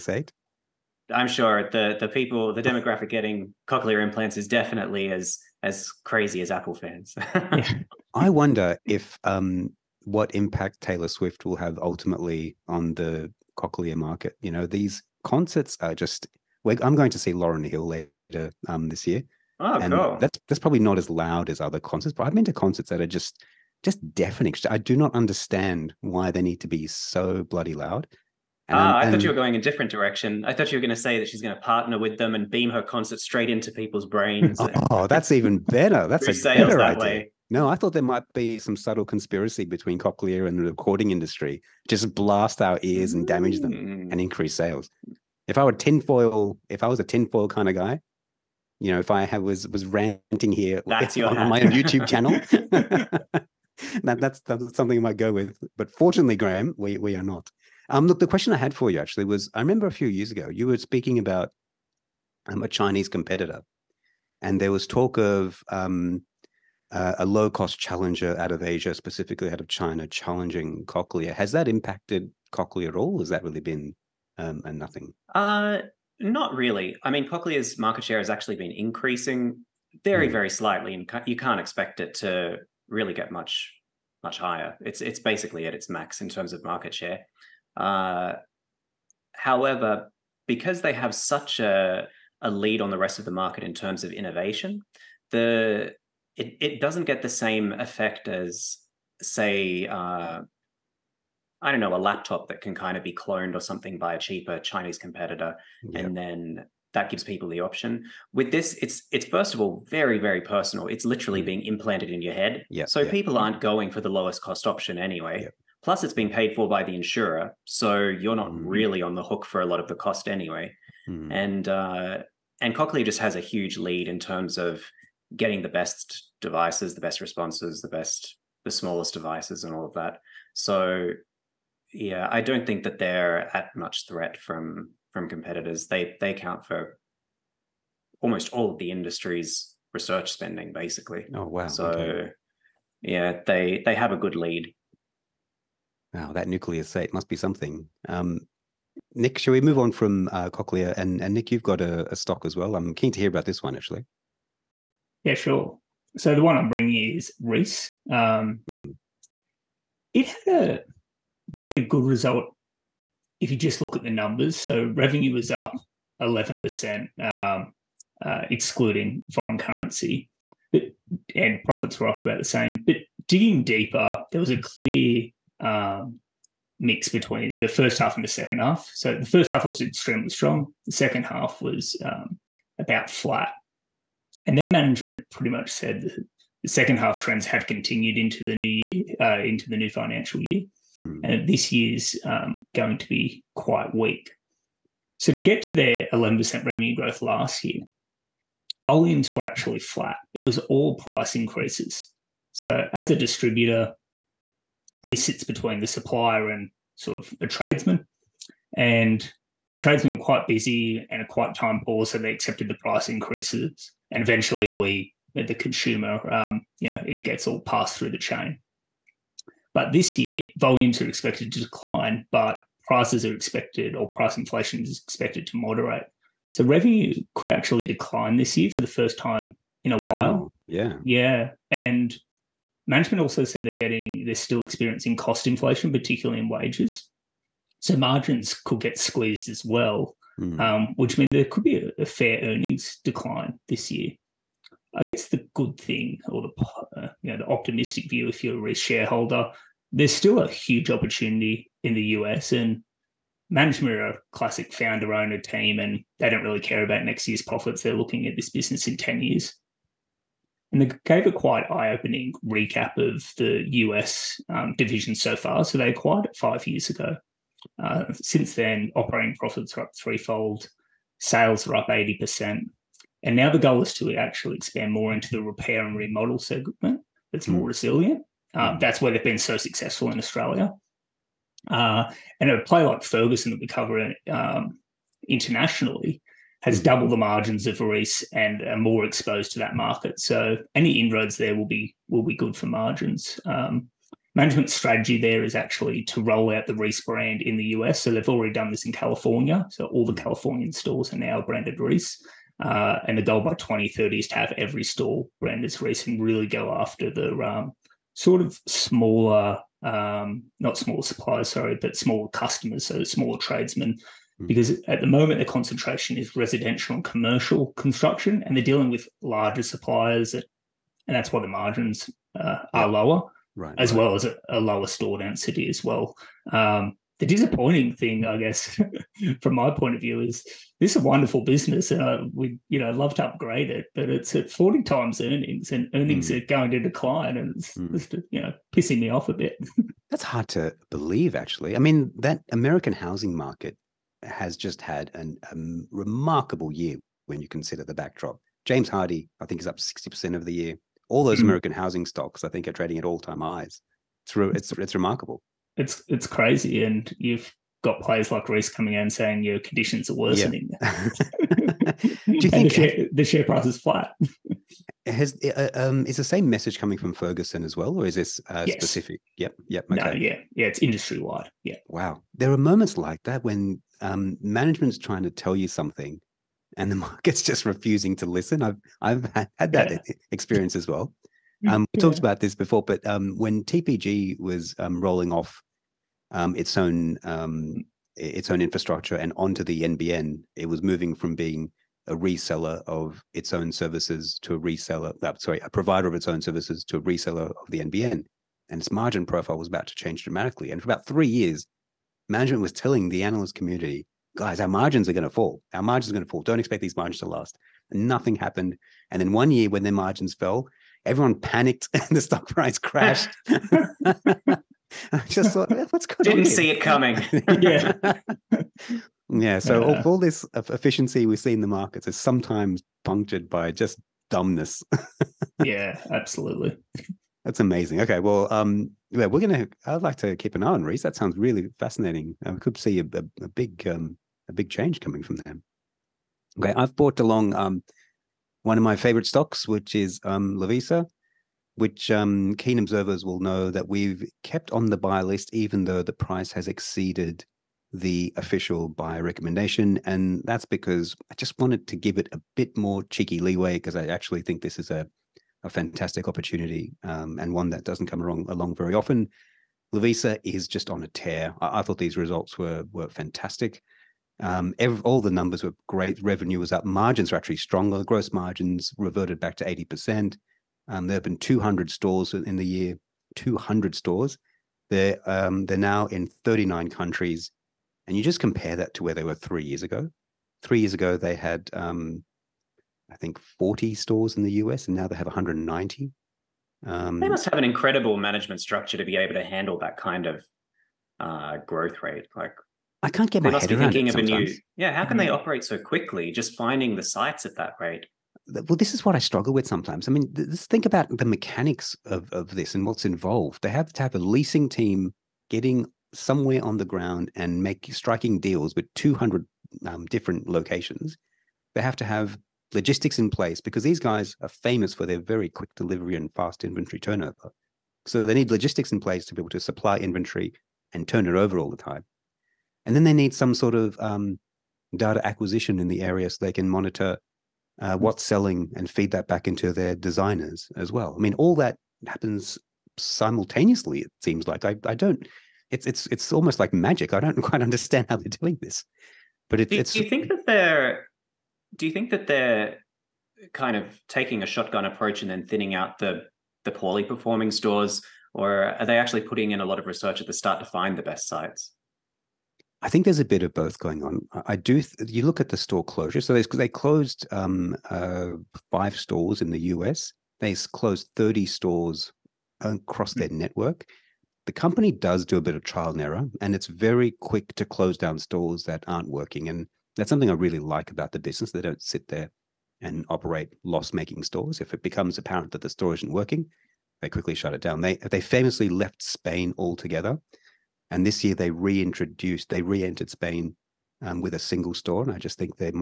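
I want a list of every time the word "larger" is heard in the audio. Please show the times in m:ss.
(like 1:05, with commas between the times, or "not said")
5:19.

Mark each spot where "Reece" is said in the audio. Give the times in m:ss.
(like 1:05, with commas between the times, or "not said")
2:37, 4:47, 4:56, 5:01, 5:05, 5:58, 7:10.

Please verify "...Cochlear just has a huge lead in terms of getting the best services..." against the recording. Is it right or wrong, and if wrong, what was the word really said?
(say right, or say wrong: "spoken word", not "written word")
wrong: "devices", not "services".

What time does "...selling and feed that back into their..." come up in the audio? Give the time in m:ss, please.
8:48.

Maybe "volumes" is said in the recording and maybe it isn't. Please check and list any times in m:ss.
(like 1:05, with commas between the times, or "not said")
3:18, 3:40.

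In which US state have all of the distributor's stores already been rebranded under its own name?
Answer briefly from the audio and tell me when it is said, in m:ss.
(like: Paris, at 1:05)
California, at 4:58.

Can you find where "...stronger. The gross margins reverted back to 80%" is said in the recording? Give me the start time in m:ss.
7:47.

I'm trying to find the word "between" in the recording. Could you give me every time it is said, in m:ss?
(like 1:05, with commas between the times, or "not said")
0:39, 2:57, 3:25.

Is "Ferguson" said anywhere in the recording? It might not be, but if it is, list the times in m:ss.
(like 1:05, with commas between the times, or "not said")
4:43, 6:07.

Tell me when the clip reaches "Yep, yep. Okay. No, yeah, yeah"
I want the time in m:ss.
6:09.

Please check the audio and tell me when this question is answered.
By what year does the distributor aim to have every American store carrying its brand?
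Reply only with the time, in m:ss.
5:03.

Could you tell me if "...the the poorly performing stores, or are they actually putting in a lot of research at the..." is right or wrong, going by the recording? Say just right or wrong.
right.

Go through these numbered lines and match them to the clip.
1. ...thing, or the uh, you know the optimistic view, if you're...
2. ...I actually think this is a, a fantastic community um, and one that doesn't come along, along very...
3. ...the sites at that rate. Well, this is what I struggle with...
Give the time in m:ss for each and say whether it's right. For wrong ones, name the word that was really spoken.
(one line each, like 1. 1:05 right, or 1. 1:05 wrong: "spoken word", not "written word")
1. 4:05 right
2. 7:33 wrong: "opportunity", not "community"
3. 8:16 right.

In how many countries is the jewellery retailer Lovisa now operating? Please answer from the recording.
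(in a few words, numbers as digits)
39.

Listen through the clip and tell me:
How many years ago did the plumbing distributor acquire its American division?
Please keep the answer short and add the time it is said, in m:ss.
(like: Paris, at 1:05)
5 years, at 4:26.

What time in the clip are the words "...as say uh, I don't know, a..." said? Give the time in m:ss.
1:38.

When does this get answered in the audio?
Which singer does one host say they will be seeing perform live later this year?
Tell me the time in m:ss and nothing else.
0:17.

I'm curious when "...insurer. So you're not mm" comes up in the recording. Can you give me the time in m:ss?
1:56.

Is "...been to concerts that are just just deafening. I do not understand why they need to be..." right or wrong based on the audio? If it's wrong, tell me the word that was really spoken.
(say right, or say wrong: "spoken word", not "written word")
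right.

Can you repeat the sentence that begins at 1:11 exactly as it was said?
Has that impacted Cochlear at all?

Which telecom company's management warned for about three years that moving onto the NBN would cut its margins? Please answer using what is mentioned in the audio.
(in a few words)
TPG.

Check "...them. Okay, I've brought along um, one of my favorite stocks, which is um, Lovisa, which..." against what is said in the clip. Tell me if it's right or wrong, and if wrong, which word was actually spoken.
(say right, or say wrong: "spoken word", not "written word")
right.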